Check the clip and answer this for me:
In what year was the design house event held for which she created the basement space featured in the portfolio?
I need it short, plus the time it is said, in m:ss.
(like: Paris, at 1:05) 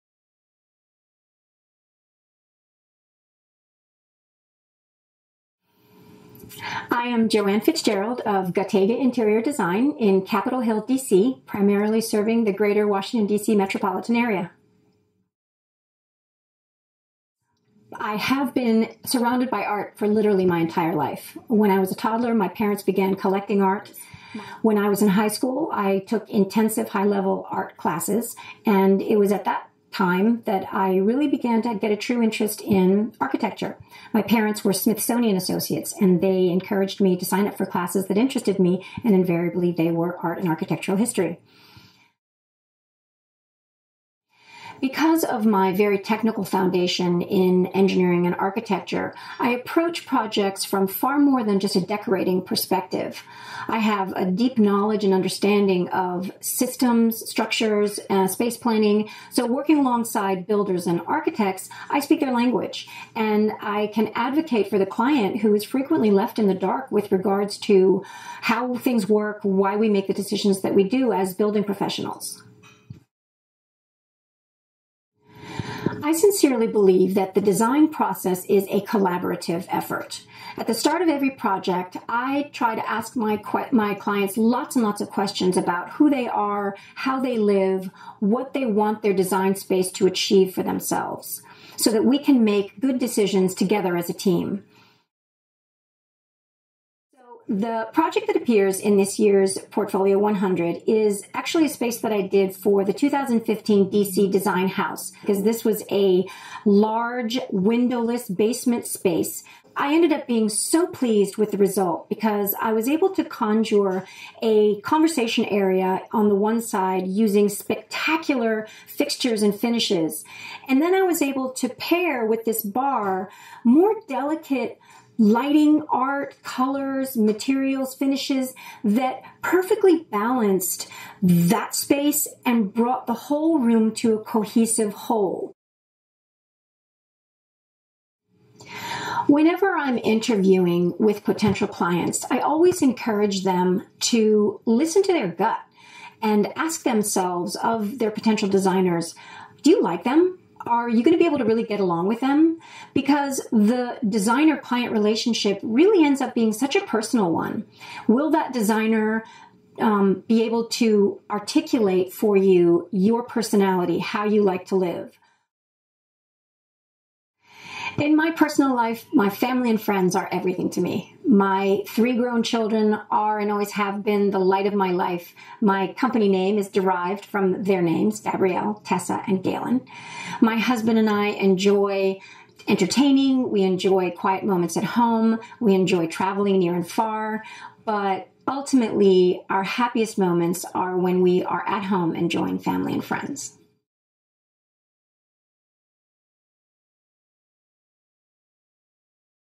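2015, at 1:42.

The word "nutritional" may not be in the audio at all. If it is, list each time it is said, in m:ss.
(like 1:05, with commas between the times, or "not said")
not said.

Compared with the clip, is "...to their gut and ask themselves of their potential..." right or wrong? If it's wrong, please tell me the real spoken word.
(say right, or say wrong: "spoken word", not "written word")
right.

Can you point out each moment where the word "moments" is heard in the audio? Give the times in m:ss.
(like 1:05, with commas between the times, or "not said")
3:04, 3:10.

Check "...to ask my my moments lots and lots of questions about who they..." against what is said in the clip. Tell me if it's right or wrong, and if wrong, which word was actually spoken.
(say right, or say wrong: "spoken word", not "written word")
wrong: "clients", not "moments".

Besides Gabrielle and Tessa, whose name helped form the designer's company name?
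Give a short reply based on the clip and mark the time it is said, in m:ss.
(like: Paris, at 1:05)
Galen, at 2:59.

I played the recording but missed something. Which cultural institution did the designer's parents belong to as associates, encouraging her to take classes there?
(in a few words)
Smithsonian.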